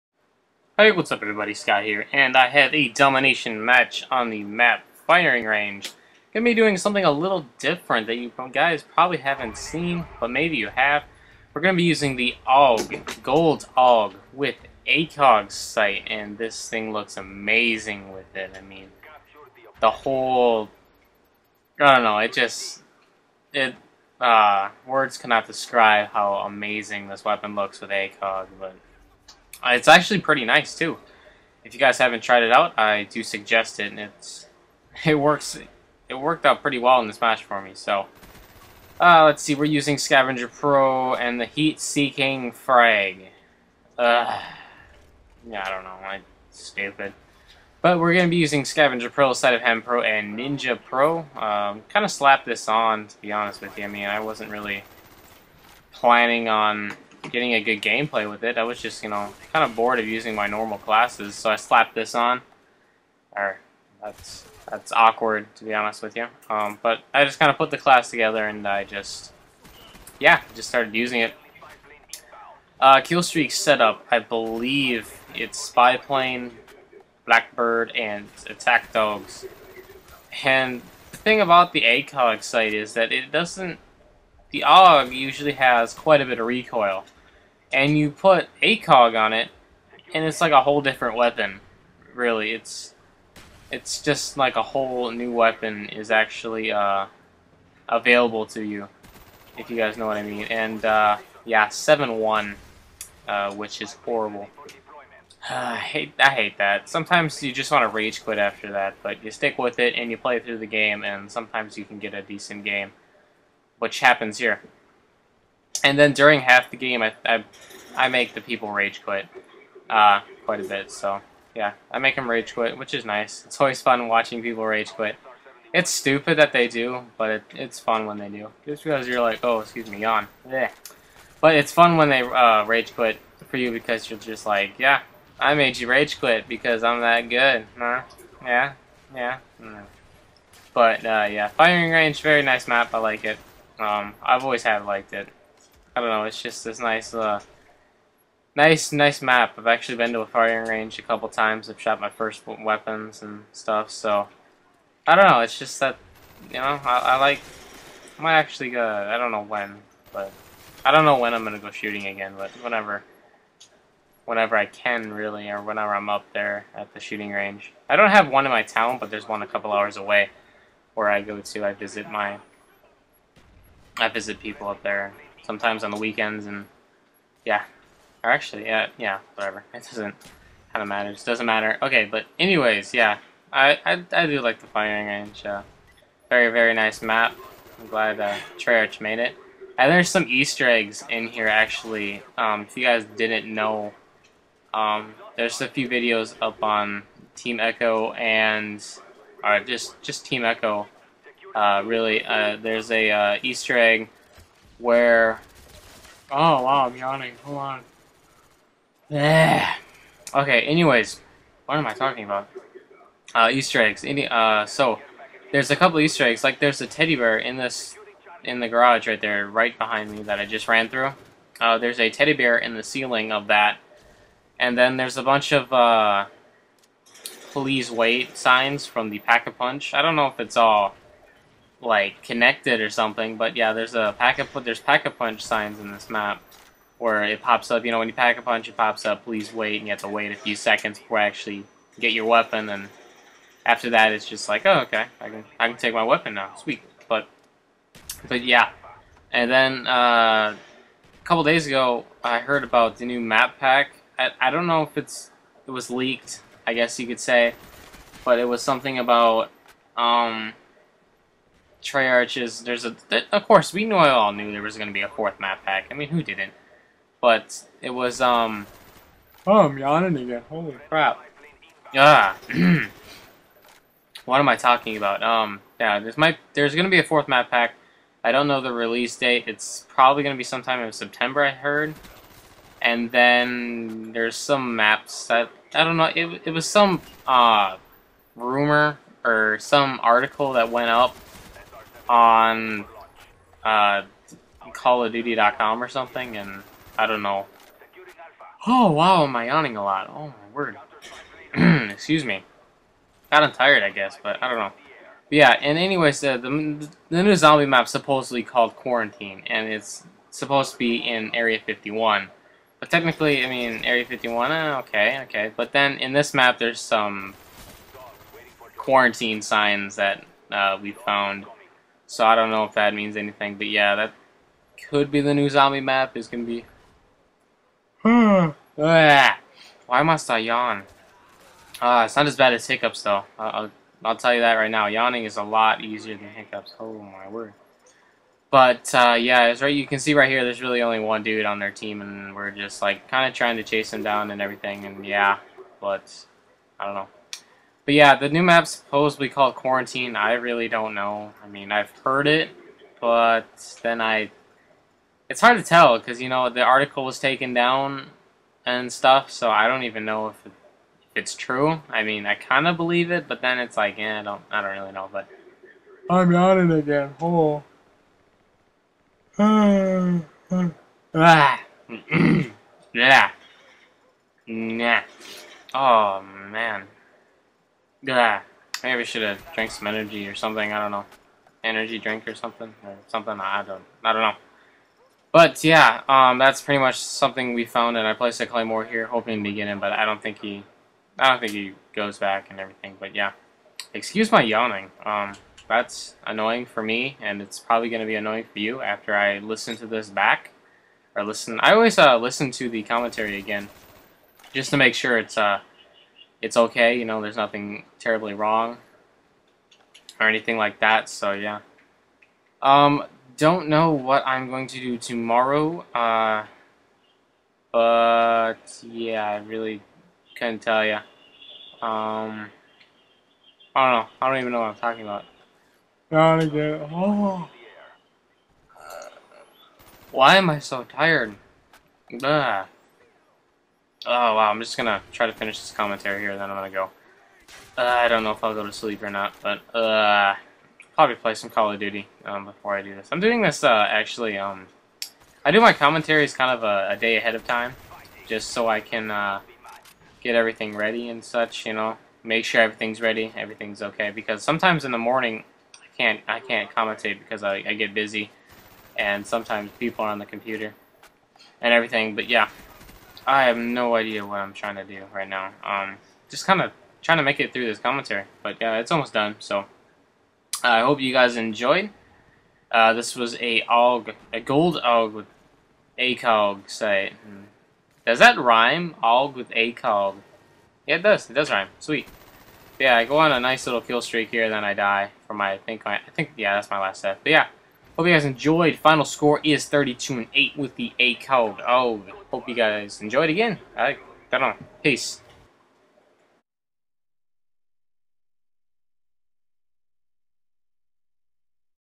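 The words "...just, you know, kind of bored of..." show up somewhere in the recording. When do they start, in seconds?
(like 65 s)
58 s.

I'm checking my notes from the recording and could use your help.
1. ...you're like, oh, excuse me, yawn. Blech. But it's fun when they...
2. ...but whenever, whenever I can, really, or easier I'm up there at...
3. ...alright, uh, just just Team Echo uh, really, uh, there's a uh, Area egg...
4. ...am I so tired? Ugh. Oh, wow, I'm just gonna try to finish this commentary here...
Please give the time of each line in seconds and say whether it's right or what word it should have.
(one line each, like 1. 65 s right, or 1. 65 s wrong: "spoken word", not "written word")
1. 129 s right
2. 162 s wrong: "whenever", not "easier"
3. 199 s wrong: "Easter", not "Area"
4. 430 s right.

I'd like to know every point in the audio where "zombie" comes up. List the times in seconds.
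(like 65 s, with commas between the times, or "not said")
307 s, 325 s.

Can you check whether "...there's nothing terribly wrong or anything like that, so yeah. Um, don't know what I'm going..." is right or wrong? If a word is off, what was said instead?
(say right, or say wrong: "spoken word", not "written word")
right.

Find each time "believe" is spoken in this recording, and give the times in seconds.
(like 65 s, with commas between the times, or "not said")
74 s, 362 s.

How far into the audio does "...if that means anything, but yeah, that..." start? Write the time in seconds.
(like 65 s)
322 s.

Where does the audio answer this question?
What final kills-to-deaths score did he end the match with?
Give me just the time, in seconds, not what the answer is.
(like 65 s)
489 s.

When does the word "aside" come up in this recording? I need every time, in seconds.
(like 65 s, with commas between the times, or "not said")
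not said.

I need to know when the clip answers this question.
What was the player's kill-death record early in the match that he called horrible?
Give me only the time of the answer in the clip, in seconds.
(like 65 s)
101 s.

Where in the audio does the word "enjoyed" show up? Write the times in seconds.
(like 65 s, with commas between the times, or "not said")
471 s, 488 s, 493 s.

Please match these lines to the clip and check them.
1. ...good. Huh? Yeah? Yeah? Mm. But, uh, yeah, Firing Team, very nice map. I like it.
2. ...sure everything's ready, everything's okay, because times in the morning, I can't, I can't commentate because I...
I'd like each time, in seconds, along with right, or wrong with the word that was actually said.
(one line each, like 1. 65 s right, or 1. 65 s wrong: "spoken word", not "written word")
1. 137 s wrong: "Range", not "Team"
2. 452 s wrong: "sometimes", not "times".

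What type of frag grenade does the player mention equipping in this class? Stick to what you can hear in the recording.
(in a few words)
Heat Seeking Frag.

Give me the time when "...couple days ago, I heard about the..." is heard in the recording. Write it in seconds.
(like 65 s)
251 s.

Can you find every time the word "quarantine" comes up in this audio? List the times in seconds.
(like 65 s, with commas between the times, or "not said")
308 s, 318 s, 349 s.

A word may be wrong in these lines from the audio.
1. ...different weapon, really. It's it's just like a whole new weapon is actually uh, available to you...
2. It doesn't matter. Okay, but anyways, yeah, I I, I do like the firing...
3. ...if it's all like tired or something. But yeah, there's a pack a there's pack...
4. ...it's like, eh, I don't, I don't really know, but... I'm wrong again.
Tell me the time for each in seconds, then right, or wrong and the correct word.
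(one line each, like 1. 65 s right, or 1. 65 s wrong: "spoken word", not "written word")
1. 90 s right
2. 181 s right
3. 230 s wrong: "connected", not "tired"
4. 363 s wrong: "yawning", not "wrong".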